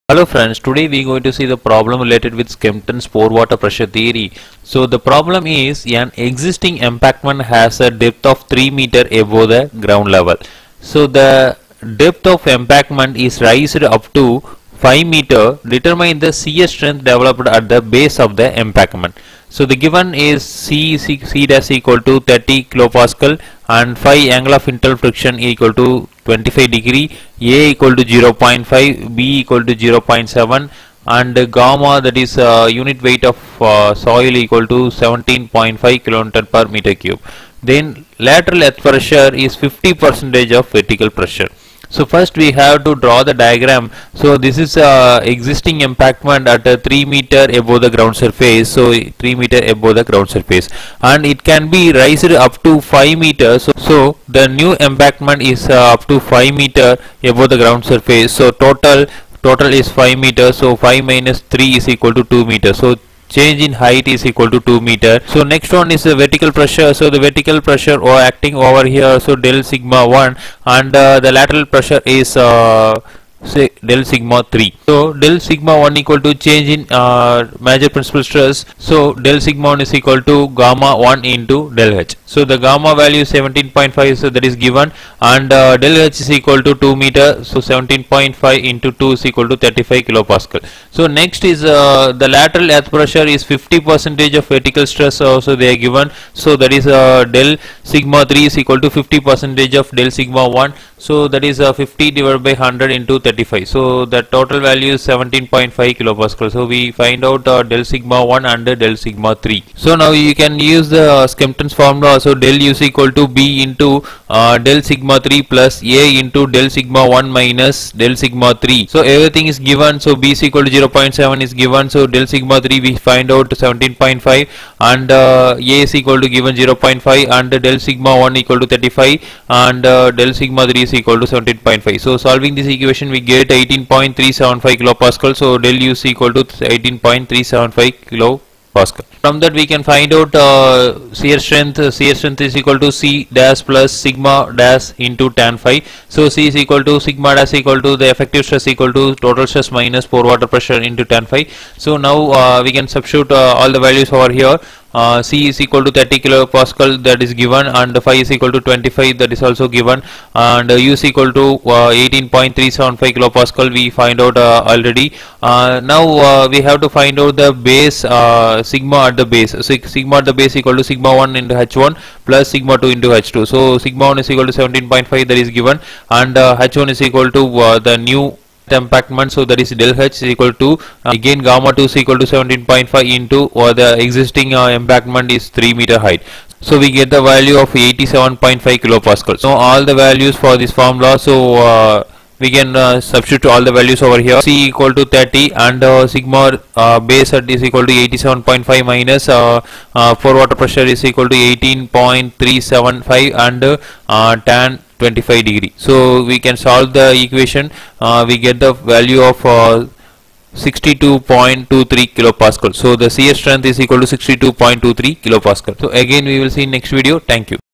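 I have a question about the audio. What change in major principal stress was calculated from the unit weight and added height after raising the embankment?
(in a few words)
35 kPa.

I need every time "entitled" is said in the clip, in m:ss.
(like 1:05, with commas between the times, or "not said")
not said.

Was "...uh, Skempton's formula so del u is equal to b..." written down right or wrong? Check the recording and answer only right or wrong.
right.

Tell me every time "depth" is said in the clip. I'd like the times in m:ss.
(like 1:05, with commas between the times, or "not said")
0:07, 0:11.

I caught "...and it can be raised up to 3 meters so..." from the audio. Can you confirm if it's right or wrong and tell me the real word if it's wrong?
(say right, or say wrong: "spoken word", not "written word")
wrong: "5", not "3".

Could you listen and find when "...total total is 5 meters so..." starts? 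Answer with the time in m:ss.
0:58.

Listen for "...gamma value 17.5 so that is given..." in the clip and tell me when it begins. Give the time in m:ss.
1:22.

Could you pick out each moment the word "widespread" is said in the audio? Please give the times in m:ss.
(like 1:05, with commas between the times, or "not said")
not said.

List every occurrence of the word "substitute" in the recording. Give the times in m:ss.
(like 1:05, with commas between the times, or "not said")
2:32, 3:12.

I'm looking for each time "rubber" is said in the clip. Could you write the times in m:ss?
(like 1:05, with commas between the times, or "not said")
not said.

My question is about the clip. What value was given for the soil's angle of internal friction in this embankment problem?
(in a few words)
25 degrees.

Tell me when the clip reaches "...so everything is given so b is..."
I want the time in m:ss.
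1:58.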